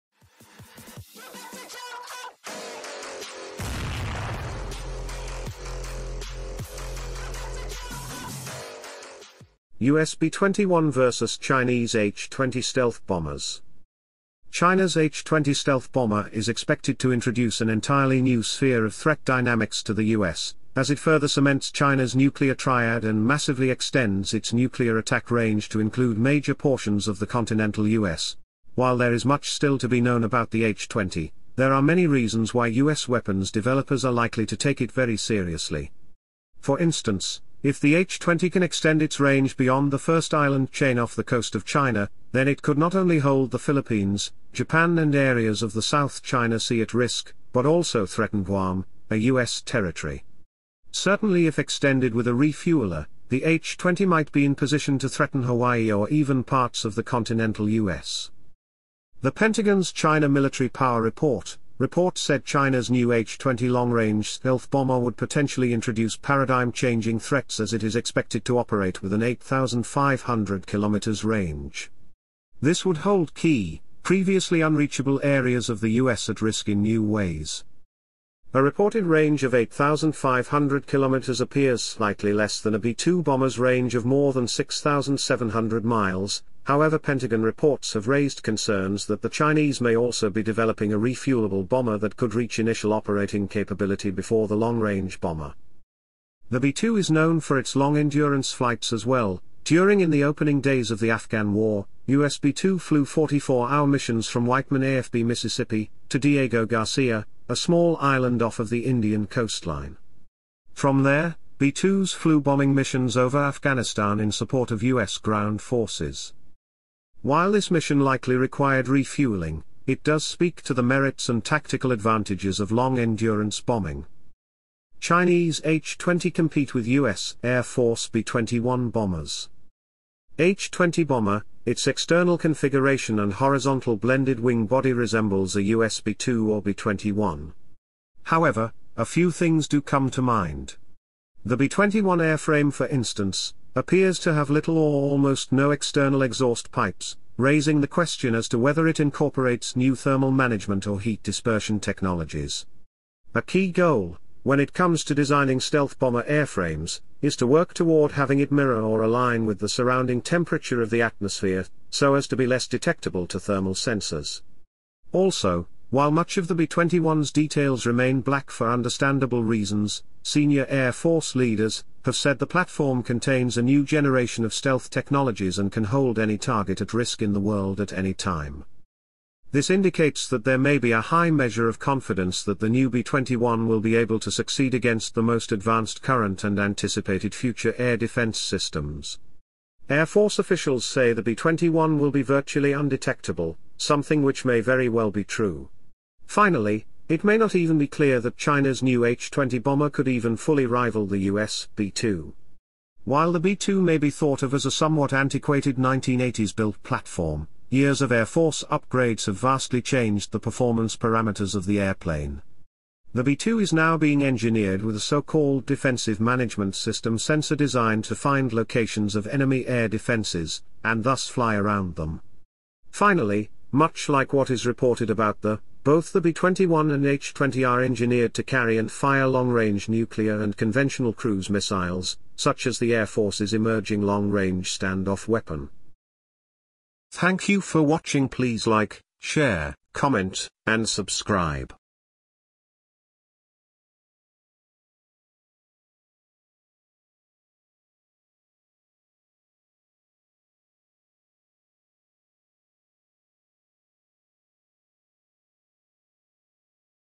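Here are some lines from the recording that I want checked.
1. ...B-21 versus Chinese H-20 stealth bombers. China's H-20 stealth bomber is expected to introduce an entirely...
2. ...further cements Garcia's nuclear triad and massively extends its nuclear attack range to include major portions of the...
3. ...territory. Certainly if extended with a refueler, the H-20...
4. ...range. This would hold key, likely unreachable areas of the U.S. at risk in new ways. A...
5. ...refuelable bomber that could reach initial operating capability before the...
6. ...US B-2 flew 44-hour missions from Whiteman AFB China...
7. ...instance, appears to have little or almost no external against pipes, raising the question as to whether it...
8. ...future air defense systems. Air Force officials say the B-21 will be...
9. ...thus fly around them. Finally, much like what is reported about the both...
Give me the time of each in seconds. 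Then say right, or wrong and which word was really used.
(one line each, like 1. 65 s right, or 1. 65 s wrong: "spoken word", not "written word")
1. 10 s right
2. 20 s wrong: "China", not "Garcia"
3. 49 s right
4. 71 s wrong: "previously", not "likely"
5. 90 s right
6. 102 s wrong: "Mississippi", not "China"
7. 142 s wrong: "exhaust", not "against"
8. 187 s right
9. 221 s right.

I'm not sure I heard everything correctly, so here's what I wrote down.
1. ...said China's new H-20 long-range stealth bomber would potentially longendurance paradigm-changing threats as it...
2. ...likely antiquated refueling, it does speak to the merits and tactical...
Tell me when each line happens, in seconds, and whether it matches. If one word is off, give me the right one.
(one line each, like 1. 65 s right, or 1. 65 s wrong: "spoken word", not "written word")
1. 62 s wrong: "introduce", not "longendurance"
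2. 117 s wrong: "required", not "antiquated".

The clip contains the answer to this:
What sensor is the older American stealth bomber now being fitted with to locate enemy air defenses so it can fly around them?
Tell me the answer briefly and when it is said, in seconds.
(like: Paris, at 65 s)
defensive management system, at 215 s.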